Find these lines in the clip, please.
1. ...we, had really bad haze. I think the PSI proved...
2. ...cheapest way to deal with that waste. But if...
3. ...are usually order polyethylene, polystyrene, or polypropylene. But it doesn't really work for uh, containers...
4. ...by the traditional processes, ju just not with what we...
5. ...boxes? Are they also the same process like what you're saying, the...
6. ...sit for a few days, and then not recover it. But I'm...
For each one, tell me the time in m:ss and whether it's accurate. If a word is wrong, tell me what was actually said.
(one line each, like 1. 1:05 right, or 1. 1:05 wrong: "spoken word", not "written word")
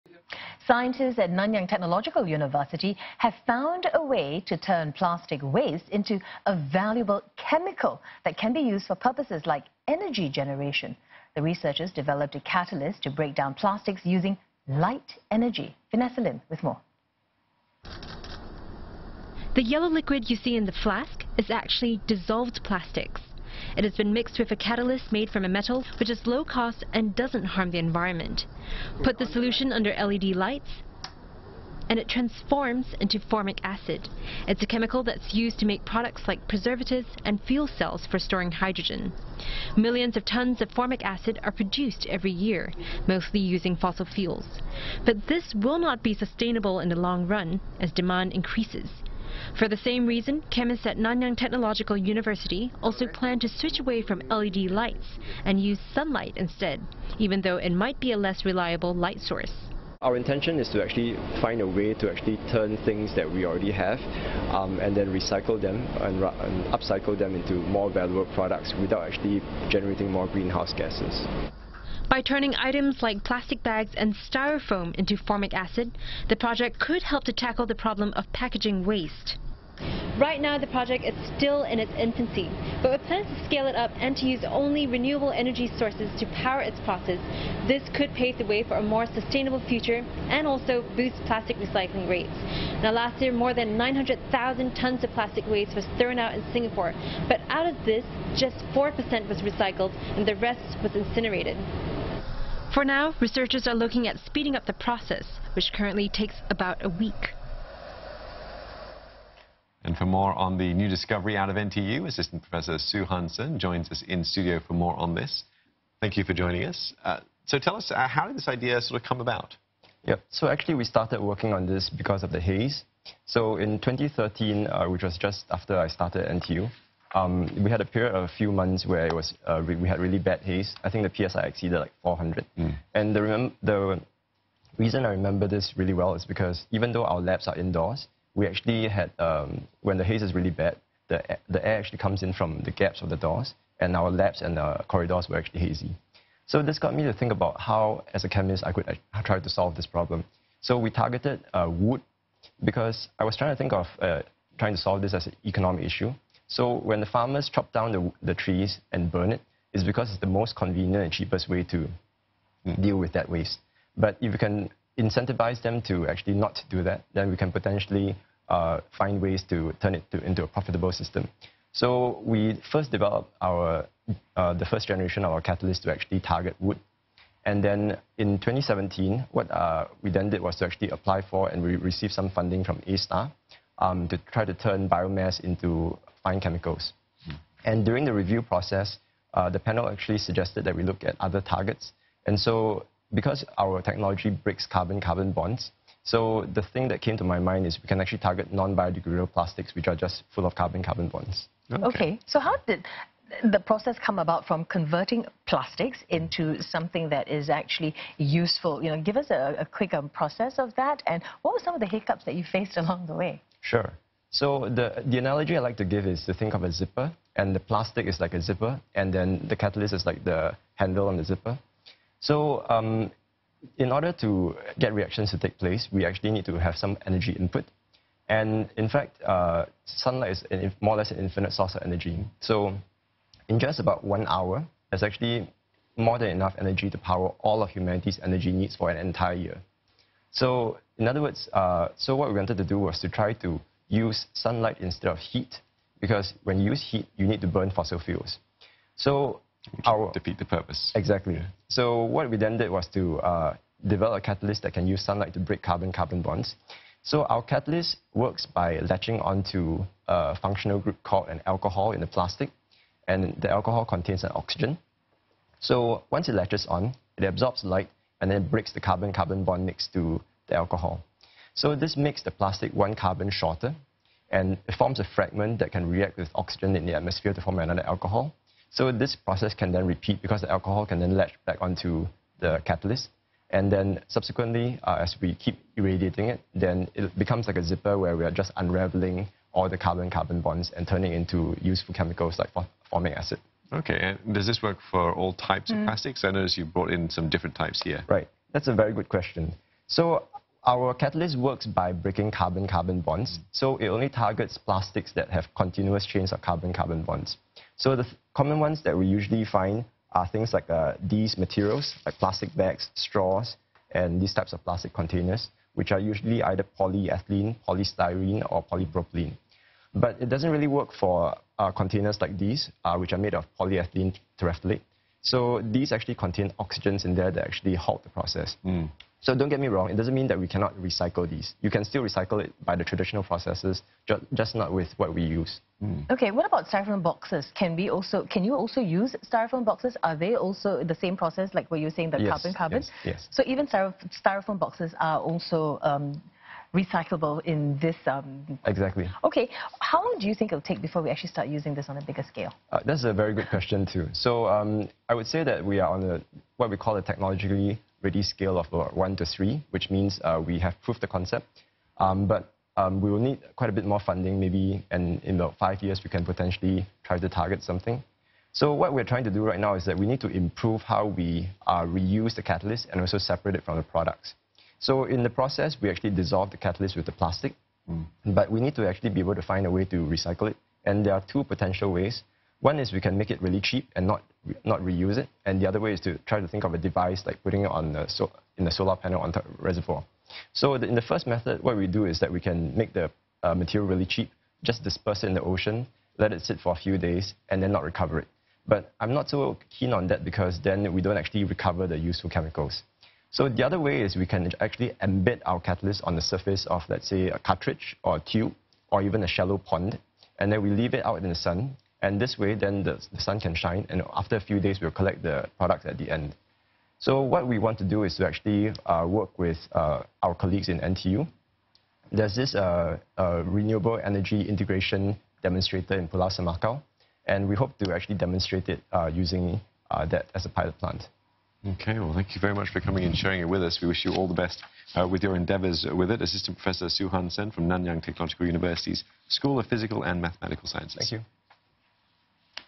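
1. 2:09 wrong: "exceeded", not "proved"
2. 2:41 right
3. 5:15 wrong: "either", not "order"
4. 5:32 right
5. 5:39 right
6. 6:36 right.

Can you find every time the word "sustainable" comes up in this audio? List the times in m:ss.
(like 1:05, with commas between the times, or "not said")
0:46, 1:29.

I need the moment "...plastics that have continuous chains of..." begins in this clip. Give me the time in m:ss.
5:04.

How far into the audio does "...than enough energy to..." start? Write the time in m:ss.
3:56.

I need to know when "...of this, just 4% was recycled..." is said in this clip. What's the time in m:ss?
1:37.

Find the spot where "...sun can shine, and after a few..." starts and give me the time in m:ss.
6:53.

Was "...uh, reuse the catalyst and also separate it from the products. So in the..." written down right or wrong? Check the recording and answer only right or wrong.
right.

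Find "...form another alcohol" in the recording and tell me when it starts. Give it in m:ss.
4:37.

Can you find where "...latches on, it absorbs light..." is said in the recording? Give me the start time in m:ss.
4:26.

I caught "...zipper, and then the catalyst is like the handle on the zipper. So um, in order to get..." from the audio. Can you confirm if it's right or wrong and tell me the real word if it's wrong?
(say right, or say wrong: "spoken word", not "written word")
right.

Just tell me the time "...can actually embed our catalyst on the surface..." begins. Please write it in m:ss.
6:44.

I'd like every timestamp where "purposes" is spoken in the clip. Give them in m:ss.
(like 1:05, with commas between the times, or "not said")
0:08, 4:10.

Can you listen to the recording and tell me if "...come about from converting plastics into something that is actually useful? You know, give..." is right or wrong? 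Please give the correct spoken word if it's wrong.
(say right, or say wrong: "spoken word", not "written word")
right.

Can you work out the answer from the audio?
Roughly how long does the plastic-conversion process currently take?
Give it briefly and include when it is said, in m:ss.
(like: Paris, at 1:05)
About a week, at 1:46.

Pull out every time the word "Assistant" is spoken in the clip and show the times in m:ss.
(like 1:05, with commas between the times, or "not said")
1:52, 7:16.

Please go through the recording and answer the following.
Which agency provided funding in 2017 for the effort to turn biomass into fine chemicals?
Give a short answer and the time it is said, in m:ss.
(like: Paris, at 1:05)
A*STAR, at 3:02.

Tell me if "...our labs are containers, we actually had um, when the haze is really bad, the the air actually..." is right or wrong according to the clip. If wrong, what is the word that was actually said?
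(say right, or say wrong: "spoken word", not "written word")
wrong: "indoors", not "containers".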